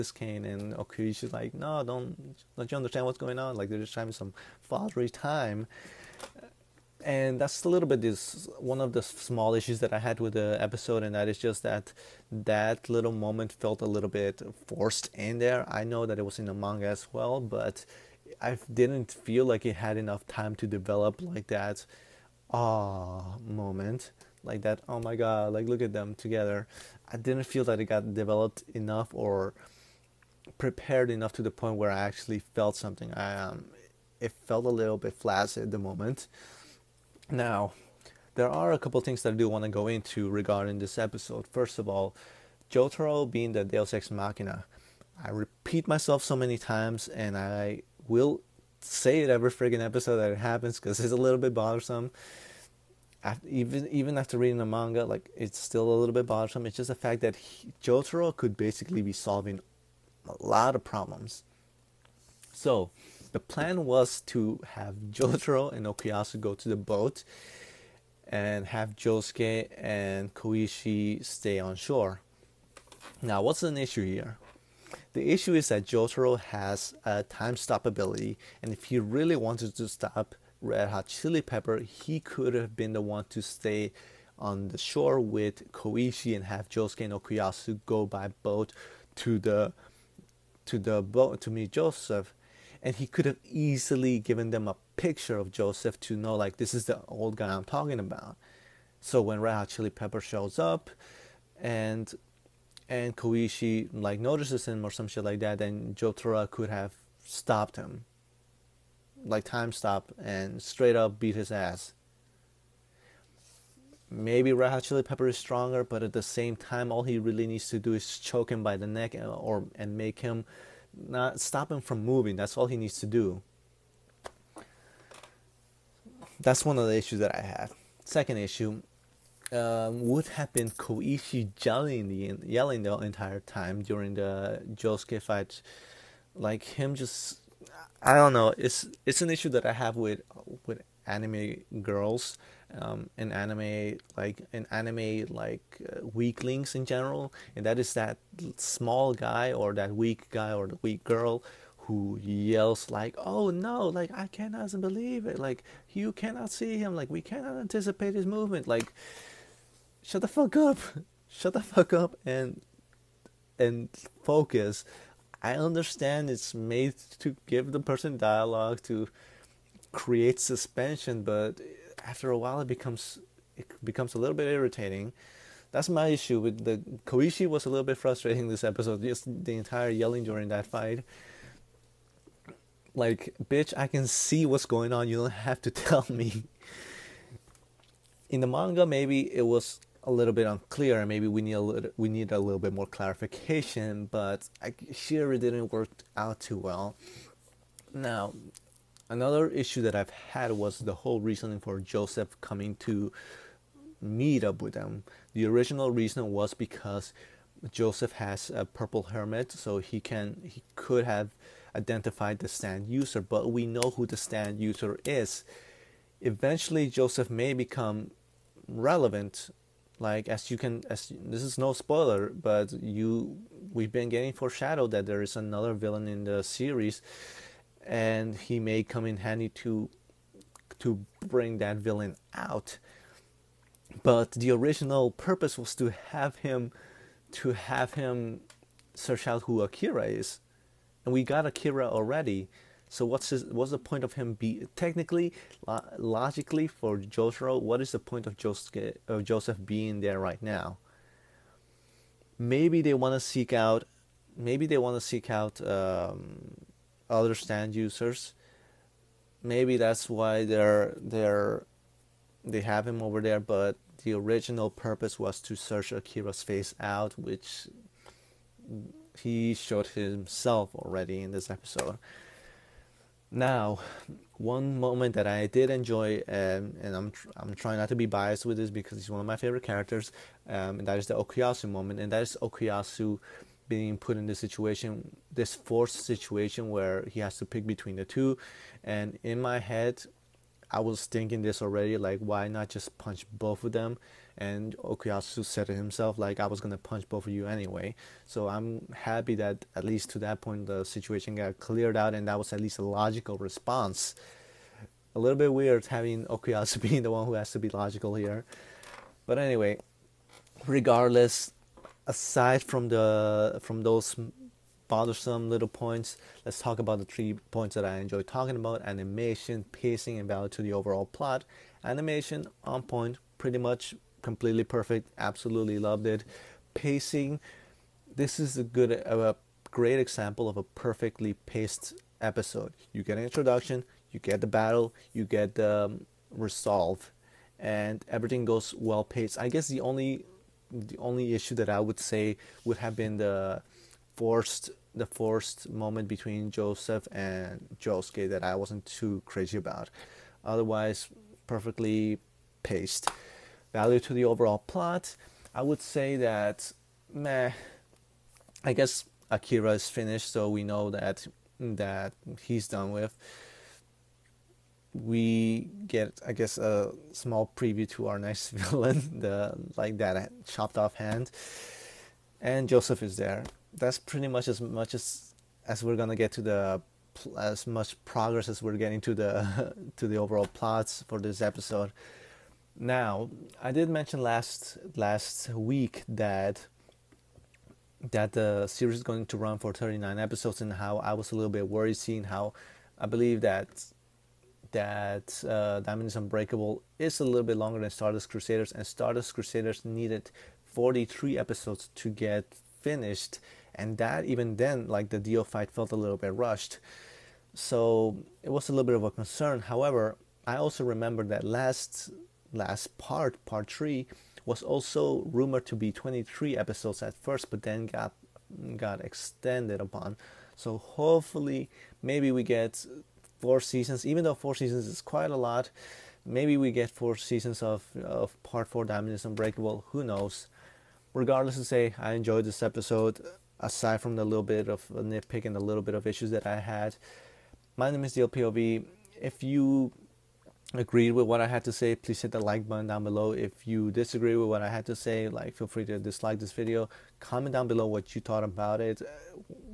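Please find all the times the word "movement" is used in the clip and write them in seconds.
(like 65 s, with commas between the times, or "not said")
158 s.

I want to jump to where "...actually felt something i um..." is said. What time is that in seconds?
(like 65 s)
31 s.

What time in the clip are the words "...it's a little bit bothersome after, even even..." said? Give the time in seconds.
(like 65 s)
50 s.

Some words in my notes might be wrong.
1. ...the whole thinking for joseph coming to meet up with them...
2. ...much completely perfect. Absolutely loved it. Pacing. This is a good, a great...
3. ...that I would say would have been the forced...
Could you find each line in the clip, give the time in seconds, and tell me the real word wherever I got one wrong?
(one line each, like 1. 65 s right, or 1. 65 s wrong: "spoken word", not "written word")
1. 200 s wrong: "reasoning", not "thinking"
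2. 323 s right
3. 341 s right.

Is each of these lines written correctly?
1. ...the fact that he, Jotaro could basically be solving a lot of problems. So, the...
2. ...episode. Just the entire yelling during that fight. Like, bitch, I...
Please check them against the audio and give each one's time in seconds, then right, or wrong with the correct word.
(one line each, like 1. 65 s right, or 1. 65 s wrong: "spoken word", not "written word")
1. 56 s right
2. 178 s right.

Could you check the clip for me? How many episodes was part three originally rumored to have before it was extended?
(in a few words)
23.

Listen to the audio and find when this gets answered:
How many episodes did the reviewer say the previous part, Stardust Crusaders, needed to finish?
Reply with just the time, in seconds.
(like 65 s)
400 s.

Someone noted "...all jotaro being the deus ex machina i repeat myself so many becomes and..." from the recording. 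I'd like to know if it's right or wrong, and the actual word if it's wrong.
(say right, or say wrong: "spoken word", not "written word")
wrong: "times", not "becomes".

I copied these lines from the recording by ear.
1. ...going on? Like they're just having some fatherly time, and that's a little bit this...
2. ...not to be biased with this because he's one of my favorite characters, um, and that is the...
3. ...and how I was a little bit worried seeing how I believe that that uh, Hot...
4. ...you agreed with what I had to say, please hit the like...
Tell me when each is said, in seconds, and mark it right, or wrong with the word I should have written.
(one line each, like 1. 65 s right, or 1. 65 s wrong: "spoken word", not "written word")
1. 3 s right
2. 277 s right
3. 390 s wrong: "Diamond", not "Hot"
4. 439 s right.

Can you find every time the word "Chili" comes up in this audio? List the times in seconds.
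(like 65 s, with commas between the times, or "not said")
81 s, 99 s, 114 s.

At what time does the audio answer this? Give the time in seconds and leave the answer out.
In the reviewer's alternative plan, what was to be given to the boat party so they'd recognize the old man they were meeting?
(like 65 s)
94 s.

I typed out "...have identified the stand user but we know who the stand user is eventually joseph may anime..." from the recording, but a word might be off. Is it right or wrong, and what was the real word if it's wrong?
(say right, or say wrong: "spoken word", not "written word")
wrong: "become", not "anime".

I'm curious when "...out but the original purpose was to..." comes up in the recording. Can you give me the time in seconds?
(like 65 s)
232 s.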